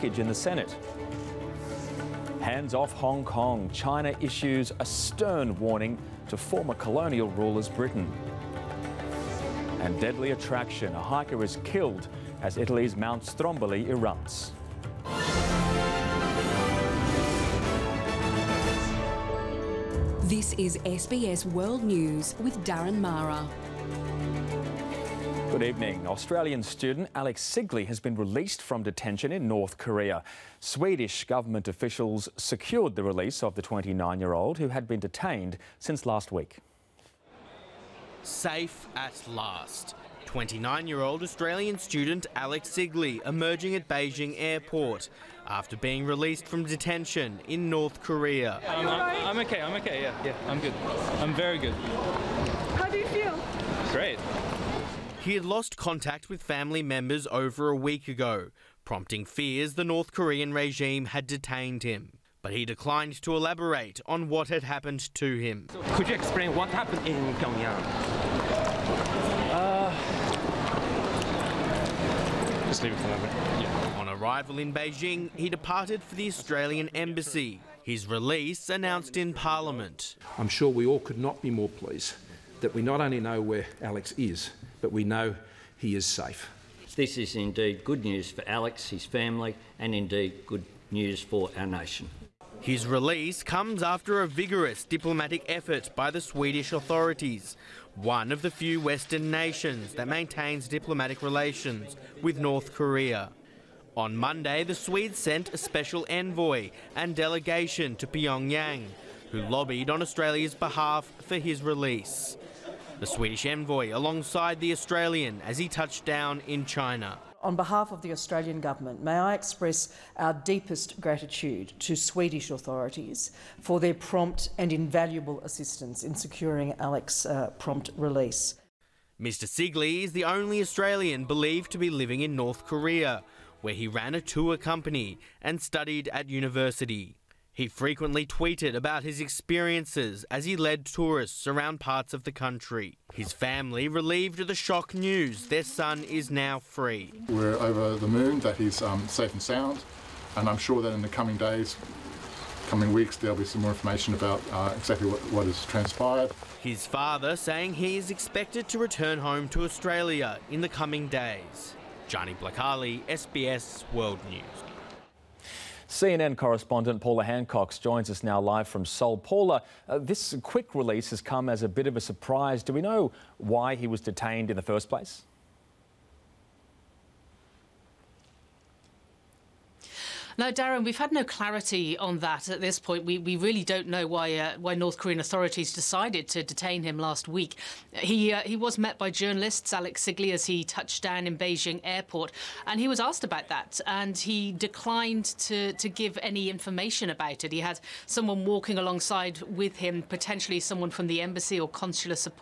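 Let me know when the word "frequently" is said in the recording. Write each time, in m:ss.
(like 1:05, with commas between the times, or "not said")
2:17.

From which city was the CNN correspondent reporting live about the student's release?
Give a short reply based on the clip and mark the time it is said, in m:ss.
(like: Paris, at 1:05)
Seoul, at 2:48.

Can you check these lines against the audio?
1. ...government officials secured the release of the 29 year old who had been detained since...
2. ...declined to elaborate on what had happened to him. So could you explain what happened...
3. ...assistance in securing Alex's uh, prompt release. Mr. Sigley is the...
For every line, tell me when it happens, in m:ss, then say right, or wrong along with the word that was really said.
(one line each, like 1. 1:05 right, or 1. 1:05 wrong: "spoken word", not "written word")
1. 0:31 right
2. 1:02 right
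3. 2:05 right.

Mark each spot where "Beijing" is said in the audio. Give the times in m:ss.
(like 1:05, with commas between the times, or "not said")
0:43, 1:14, 3:11.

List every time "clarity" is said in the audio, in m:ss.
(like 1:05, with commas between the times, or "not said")
3:01.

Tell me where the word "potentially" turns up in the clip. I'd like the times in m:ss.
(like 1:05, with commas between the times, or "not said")
3:20.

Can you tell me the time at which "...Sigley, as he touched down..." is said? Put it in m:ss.
3:10.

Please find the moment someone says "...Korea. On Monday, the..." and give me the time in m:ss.
1:42.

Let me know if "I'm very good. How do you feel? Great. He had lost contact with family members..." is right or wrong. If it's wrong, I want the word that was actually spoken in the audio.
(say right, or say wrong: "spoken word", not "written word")
right.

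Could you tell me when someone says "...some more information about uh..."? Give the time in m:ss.
2:33.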